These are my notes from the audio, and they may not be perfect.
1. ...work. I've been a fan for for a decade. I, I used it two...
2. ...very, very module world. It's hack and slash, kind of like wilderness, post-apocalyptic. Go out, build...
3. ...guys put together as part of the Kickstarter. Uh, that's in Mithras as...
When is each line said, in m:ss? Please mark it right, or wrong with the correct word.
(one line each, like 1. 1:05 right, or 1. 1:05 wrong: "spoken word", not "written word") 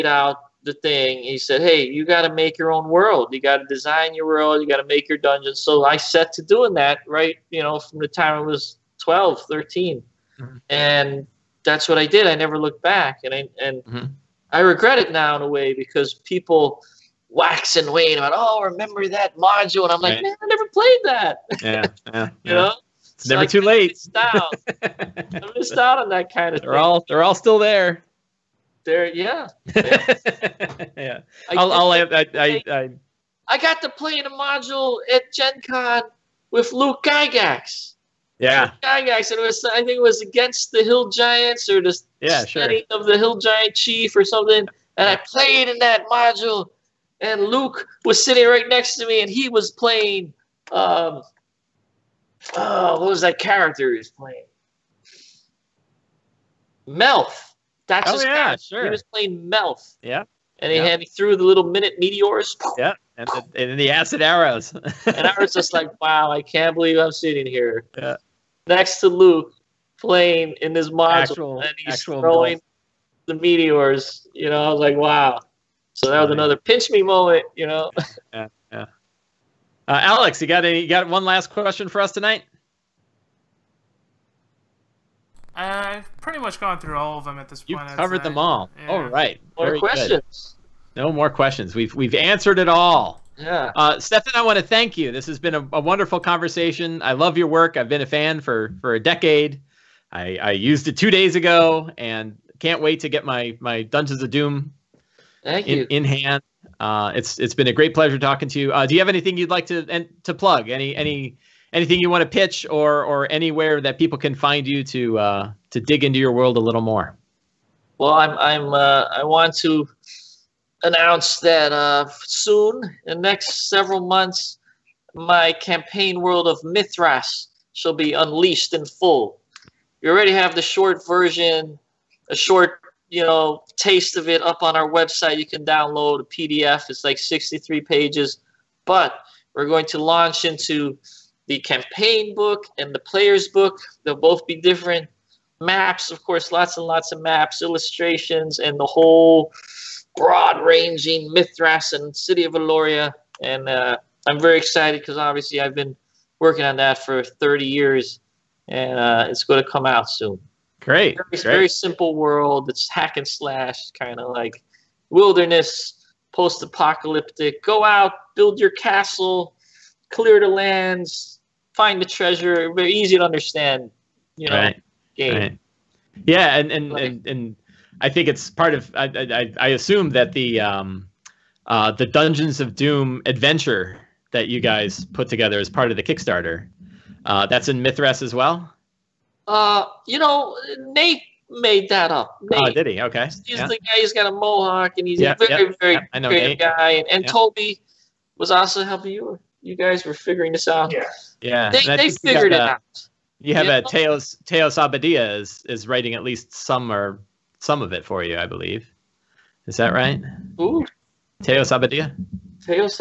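1. 1:37 right
2. 2:41 wrong: "simple", not "module"
3. 3:04 right.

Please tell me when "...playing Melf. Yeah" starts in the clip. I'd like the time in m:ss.
0:59.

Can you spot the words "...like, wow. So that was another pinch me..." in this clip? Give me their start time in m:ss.
1:14.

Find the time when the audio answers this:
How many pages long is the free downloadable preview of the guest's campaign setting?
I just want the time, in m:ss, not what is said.
2:17.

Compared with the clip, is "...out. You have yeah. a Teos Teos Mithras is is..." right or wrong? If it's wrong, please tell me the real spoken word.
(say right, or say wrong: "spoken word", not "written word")
wrong: "Abadia", not "Mithras".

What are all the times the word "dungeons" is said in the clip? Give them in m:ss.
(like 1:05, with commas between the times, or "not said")
0:05, 1:43, 3:02.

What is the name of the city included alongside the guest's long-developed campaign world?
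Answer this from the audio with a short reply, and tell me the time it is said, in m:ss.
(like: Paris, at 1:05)
City of Eloria, at 2:32.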